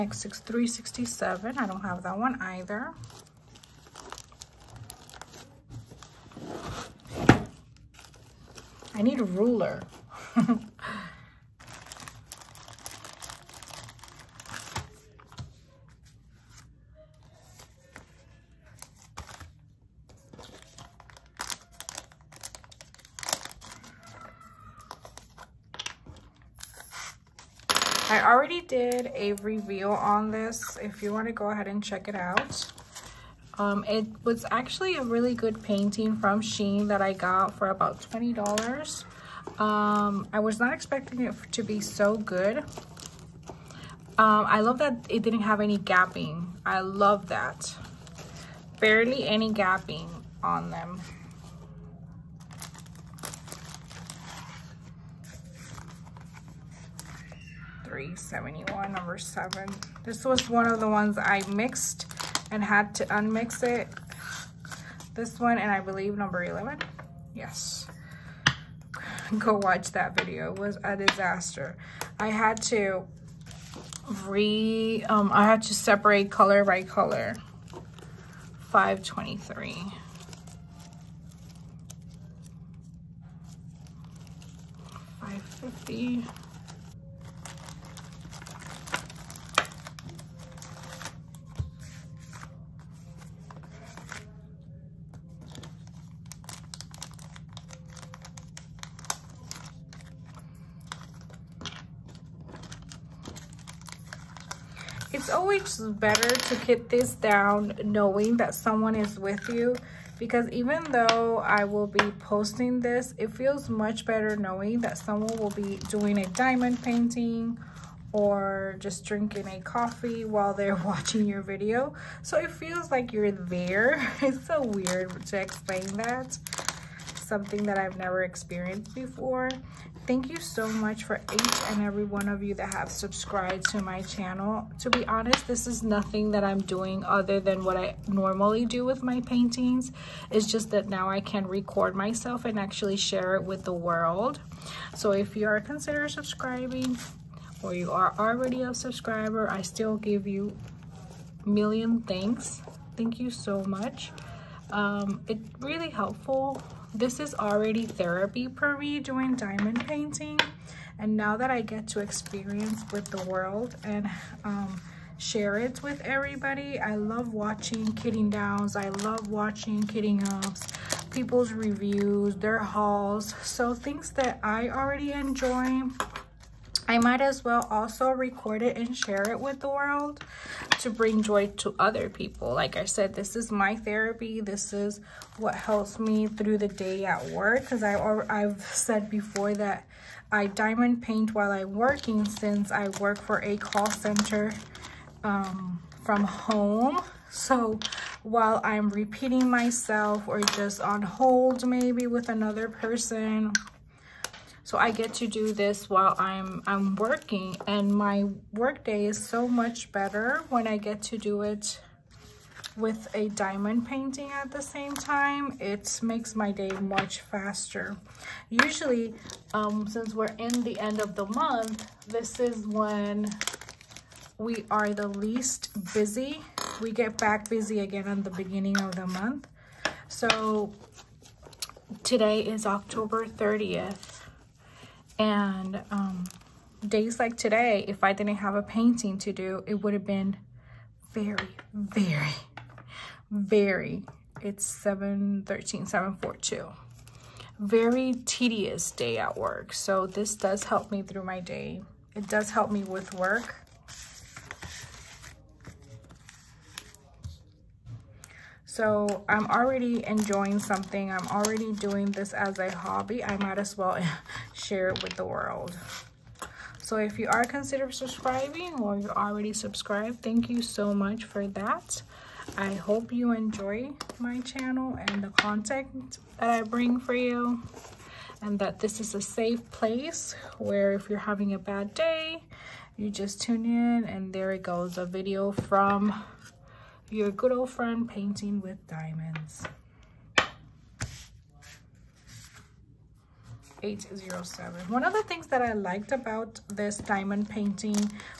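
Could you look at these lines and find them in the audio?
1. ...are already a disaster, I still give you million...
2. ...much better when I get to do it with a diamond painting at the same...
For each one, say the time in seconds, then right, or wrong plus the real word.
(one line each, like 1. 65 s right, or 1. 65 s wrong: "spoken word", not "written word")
1. 147 s wrong: "subscriber", not "disaster"
2. 209 s right.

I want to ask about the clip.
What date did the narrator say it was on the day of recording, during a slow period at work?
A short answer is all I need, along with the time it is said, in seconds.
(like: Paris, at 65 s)
October 30th, at 232 s.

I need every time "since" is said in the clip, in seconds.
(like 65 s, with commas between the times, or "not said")
192 s, 219 s.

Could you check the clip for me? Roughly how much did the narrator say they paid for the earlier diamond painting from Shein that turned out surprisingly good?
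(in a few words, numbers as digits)
$20.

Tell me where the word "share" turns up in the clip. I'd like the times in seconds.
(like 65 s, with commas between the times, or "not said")
142 s, 165 s, 178 s, 264 s.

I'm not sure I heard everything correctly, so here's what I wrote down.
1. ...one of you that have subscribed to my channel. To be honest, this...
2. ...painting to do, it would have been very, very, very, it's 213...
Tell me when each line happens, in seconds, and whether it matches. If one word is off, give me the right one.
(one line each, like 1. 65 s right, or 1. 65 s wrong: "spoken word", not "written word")
1. 132 s right
2. 238 s wrong: "713", not "213".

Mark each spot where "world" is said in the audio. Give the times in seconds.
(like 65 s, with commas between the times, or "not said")
143 s, 163 s, 179 s, 265 s.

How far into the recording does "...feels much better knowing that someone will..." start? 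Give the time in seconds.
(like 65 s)
113 s.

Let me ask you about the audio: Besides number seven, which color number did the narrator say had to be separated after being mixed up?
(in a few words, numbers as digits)
11.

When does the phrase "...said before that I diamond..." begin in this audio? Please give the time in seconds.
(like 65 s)
188 s.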